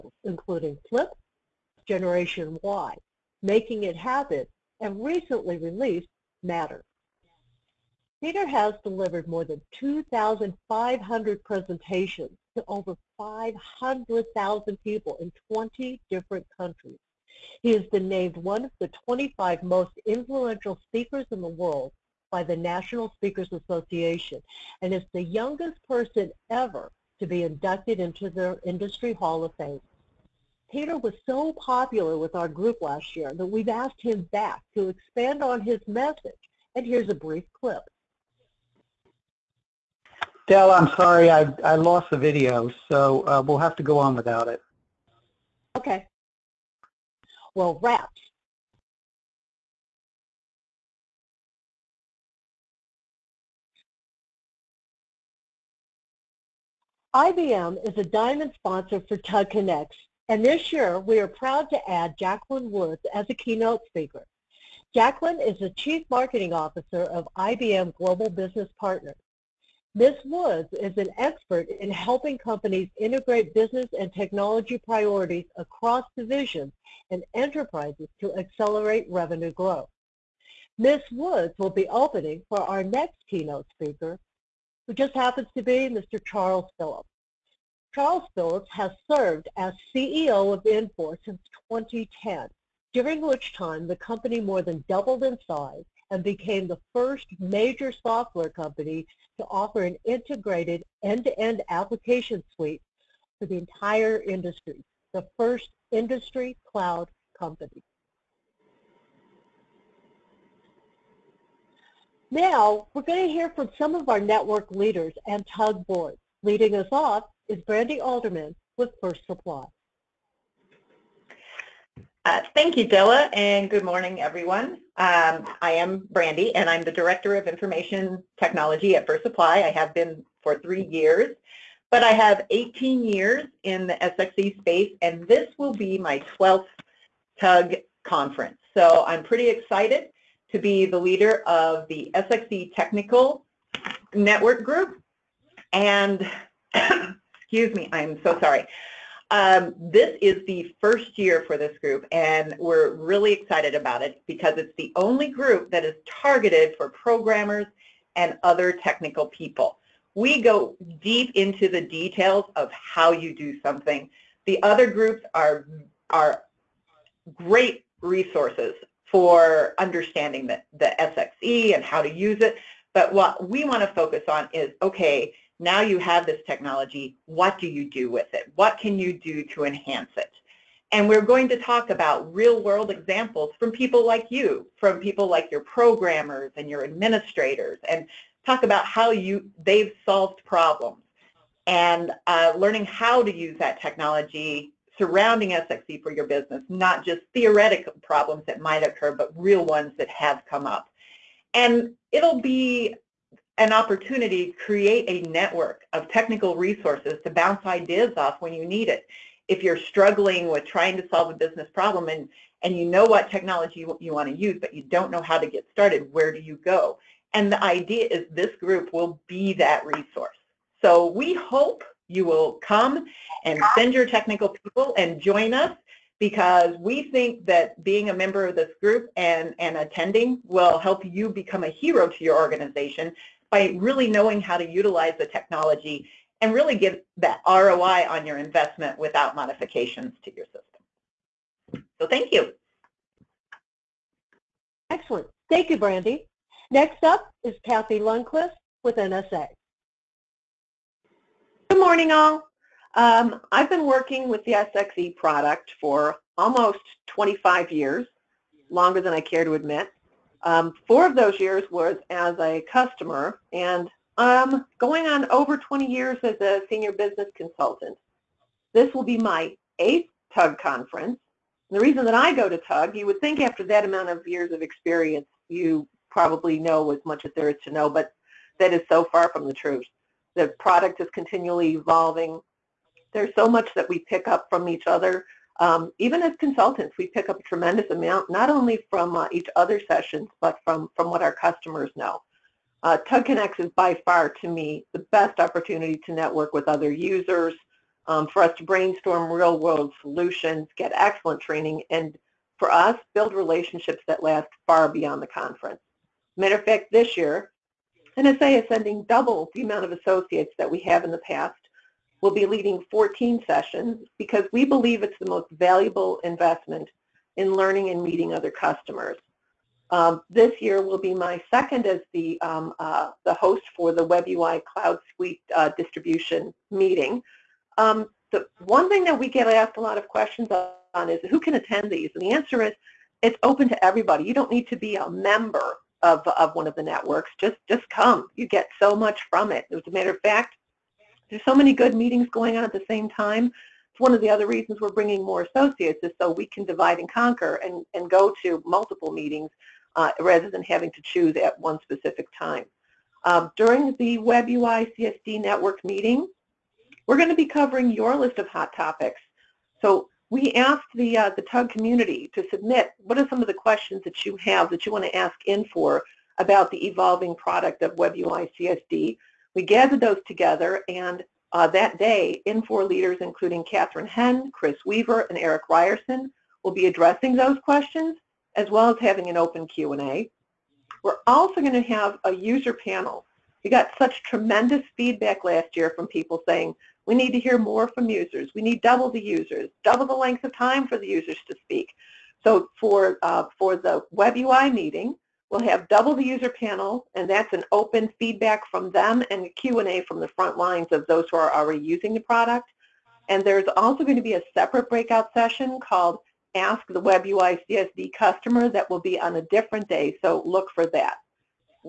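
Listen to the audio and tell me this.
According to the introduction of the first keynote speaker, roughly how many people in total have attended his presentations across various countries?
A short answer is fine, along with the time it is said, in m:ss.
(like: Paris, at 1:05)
500,000, at 0:13.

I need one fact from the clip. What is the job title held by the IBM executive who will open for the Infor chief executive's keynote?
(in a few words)
Chief Marketing Officer.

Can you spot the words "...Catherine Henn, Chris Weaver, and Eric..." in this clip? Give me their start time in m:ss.
6:13.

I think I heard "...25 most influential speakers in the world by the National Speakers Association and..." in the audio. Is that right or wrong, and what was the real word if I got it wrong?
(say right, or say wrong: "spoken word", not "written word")
right.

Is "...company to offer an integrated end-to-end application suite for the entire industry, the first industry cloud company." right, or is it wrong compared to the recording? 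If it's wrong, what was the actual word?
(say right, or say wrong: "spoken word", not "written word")
right.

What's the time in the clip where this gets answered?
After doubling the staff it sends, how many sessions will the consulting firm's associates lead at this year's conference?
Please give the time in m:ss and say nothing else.
5:12.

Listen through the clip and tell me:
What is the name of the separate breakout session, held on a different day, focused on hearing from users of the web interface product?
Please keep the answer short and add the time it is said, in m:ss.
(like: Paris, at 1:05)
Ask the Web UI CSD Customer, at 6:46.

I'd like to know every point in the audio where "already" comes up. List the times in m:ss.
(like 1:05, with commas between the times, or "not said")
6:41.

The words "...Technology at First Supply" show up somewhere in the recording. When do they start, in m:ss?
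2:08.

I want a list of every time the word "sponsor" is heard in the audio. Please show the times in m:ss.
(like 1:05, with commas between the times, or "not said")
0:58.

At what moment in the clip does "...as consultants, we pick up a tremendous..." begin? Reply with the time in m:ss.
4:46.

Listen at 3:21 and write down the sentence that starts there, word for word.
And it'll be an opportunity to create a network of technical resources to bounce ideas off when you need it.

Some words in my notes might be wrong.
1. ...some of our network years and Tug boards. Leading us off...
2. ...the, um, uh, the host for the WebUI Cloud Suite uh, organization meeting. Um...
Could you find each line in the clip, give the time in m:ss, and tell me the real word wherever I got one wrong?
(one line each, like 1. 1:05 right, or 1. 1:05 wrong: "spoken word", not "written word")
1. 1:53 wrong: "leaders", not "years"
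2. 5:22 wrong: "distribution", not "organization".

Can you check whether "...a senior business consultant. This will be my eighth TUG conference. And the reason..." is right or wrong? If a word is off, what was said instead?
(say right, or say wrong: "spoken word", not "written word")
right.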